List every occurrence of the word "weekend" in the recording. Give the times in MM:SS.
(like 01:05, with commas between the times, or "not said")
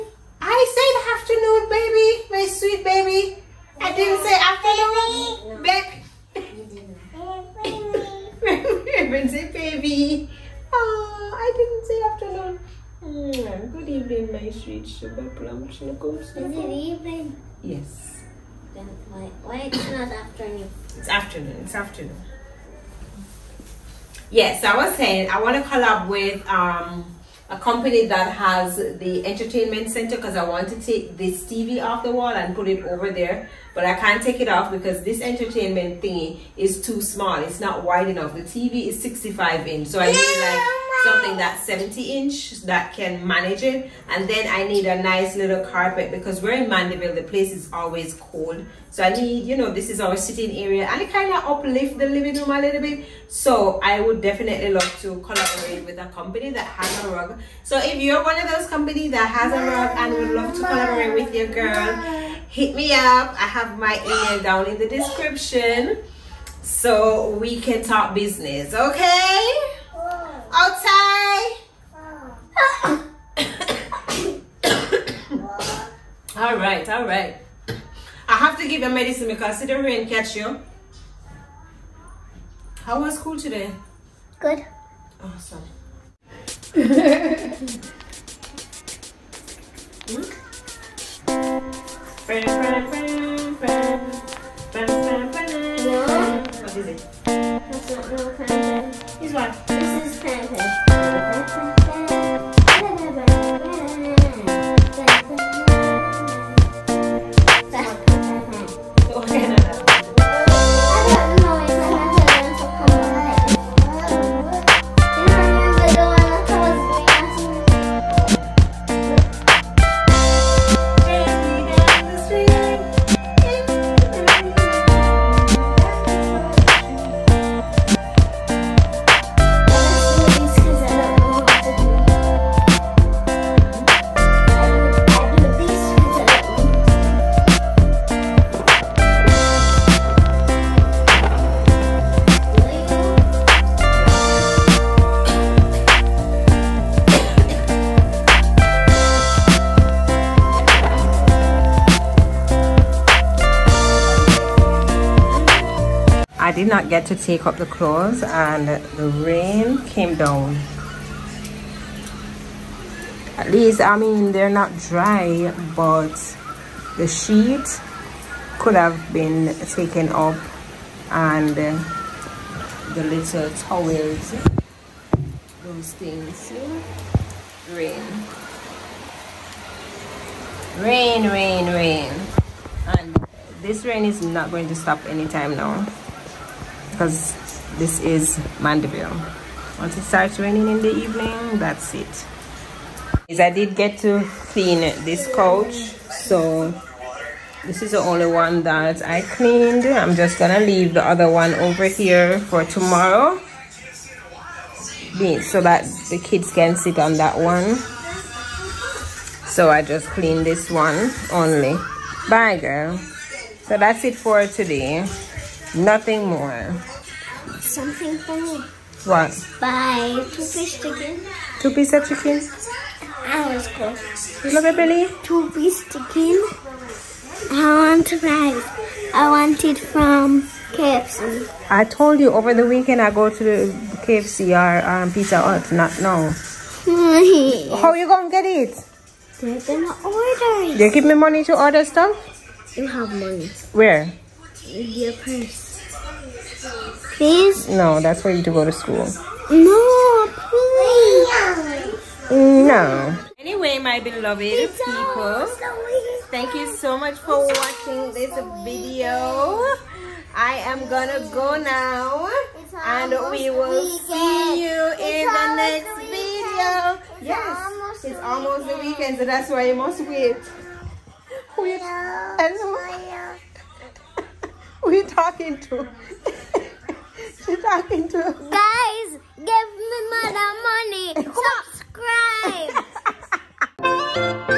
03:52, 04:28.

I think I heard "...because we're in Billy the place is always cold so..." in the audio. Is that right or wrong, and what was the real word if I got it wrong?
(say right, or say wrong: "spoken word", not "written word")
wrong: "Mandeville", not "Billy".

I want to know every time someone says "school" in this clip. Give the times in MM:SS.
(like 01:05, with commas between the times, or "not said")
01:23, 04:08.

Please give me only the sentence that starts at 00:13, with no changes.
Mm, good evening, my sweet sugar plum chinookums.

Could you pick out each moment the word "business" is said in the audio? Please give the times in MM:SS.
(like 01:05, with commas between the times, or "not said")
01:08.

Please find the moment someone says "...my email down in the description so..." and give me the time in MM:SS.
01:03.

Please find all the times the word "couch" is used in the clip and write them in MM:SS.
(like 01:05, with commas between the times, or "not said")
03:15.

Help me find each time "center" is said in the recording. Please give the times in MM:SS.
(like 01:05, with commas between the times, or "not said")
00:29.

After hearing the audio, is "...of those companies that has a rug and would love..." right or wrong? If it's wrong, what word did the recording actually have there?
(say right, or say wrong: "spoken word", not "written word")
right.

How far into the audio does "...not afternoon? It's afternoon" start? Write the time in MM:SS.
00:19.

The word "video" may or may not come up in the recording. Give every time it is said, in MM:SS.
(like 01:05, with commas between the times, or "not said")
04:18, 04:25.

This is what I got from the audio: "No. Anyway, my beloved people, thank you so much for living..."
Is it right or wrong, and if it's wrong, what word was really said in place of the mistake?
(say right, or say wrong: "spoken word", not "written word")
wrong: "watching", not "living".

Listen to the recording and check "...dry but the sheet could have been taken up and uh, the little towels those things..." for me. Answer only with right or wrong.
right.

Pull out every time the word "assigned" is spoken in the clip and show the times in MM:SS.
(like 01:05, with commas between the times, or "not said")
not said.